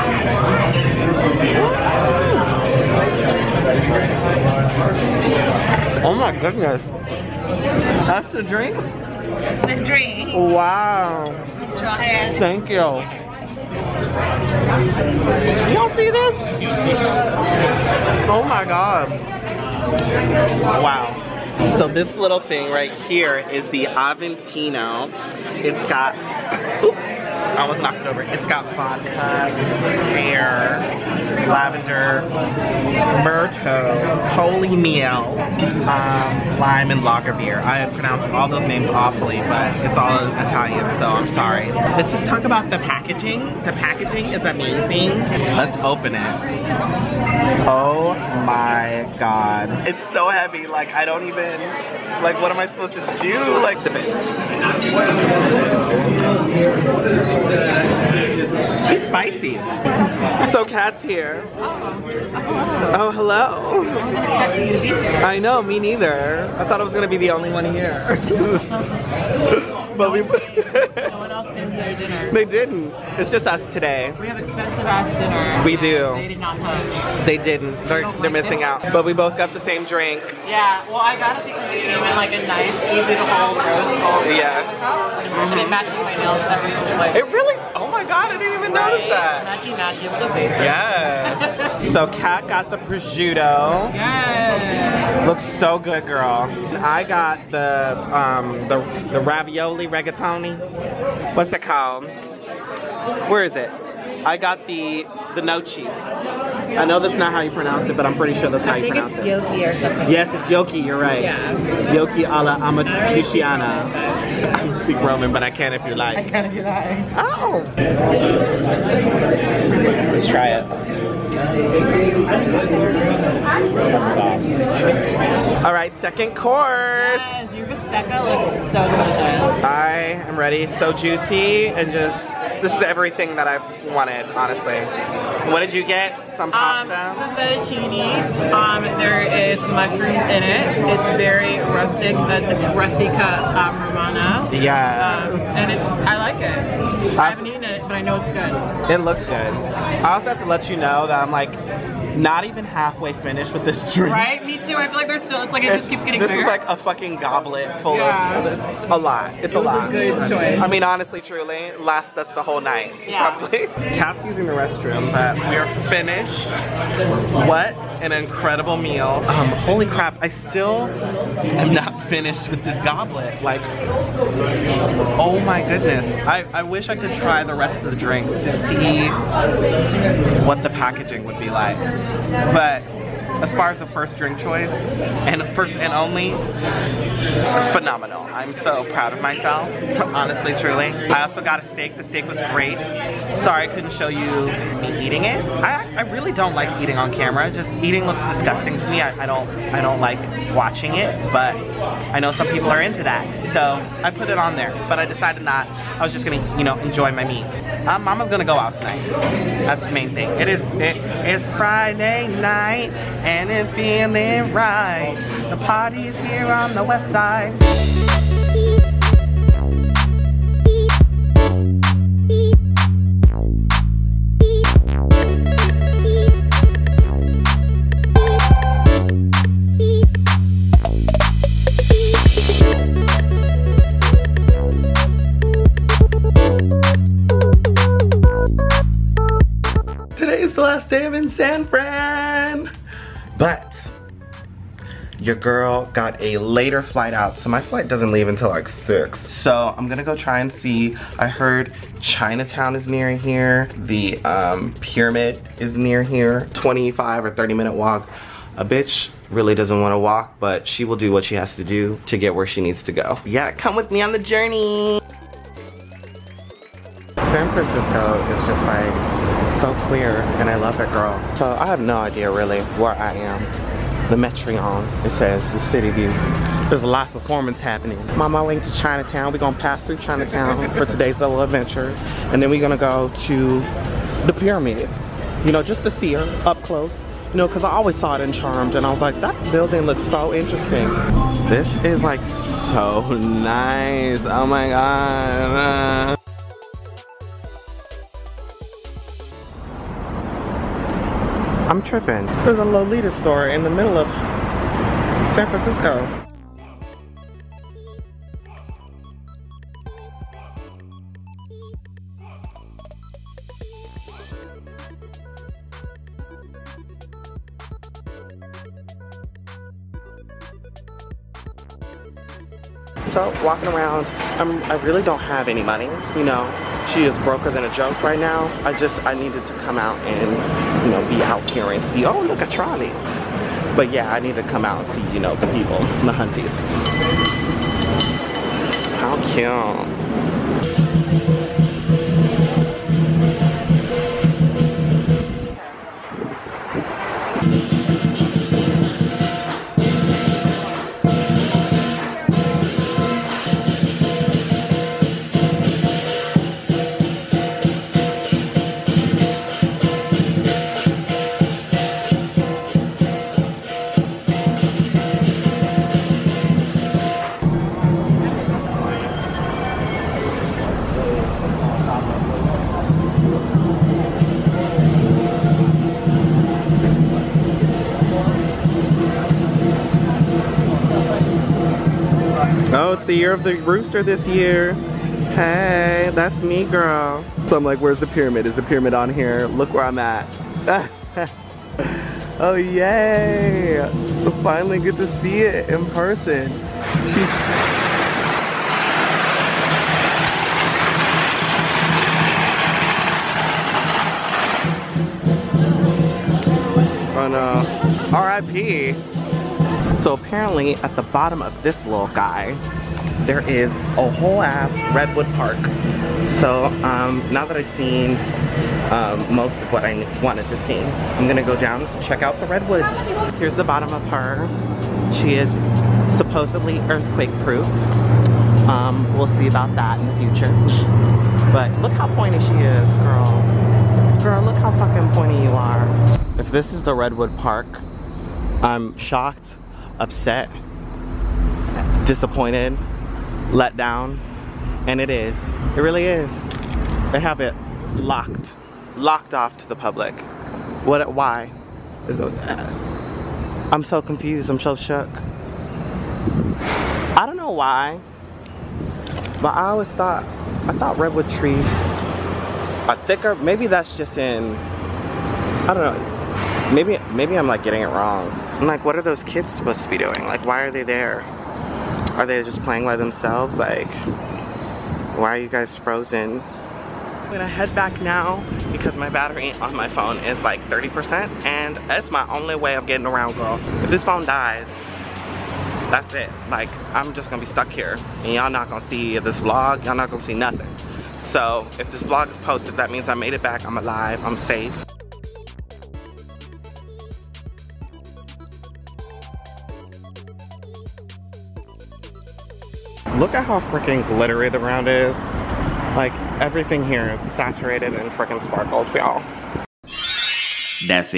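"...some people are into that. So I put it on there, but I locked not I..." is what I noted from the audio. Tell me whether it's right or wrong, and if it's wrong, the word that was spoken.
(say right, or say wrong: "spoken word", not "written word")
wrong: "decided", not "locked".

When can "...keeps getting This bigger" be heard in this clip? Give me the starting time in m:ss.
2:35.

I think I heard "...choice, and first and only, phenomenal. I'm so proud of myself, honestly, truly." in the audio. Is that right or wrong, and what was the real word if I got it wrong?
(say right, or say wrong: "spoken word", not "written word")
right.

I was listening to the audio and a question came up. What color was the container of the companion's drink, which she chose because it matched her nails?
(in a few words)
Rose gold.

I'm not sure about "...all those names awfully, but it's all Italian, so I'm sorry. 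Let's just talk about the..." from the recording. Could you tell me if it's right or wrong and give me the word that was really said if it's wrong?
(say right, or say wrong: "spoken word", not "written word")
right.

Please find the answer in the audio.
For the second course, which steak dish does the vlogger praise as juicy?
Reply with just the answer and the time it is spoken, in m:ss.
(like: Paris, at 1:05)
Bistecca, at 2:07.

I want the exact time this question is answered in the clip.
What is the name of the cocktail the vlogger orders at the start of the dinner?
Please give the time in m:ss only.
0:23.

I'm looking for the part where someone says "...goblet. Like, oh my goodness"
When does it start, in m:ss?
2:52.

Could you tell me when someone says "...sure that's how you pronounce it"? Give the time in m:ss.
1:48.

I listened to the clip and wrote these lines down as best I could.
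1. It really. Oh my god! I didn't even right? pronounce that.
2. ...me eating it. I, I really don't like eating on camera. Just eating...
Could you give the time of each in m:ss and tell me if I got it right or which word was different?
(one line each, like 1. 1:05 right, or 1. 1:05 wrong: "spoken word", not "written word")
1. 1:27 wrong: "notice", not "pronounce"
2. 3:14 right.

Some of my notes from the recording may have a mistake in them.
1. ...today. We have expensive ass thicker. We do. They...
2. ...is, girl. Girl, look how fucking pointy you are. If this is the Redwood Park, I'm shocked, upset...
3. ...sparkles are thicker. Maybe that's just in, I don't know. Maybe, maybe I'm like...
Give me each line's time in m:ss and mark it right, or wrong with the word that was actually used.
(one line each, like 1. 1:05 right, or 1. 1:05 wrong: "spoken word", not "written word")
1. 1:13 wrong: "dinner", not "thicker"
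2. 7:12 right
3. 7:41 wrong: "trees", not "sparkles".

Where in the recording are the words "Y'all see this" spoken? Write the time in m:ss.
0:15.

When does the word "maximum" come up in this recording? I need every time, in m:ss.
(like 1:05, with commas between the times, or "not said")
not said.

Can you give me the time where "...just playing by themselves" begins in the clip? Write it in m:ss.
7:52.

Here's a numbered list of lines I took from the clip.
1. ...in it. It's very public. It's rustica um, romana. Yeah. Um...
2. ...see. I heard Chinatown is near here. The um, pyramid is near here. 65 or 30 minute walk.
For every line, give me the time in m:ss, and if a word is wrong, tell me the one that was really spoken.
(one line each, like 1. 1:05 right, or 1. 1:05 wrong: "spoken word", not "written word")
1. 2:20 wrong: "rustic", not "public"
2. 4:10 wrong: "25", not "65".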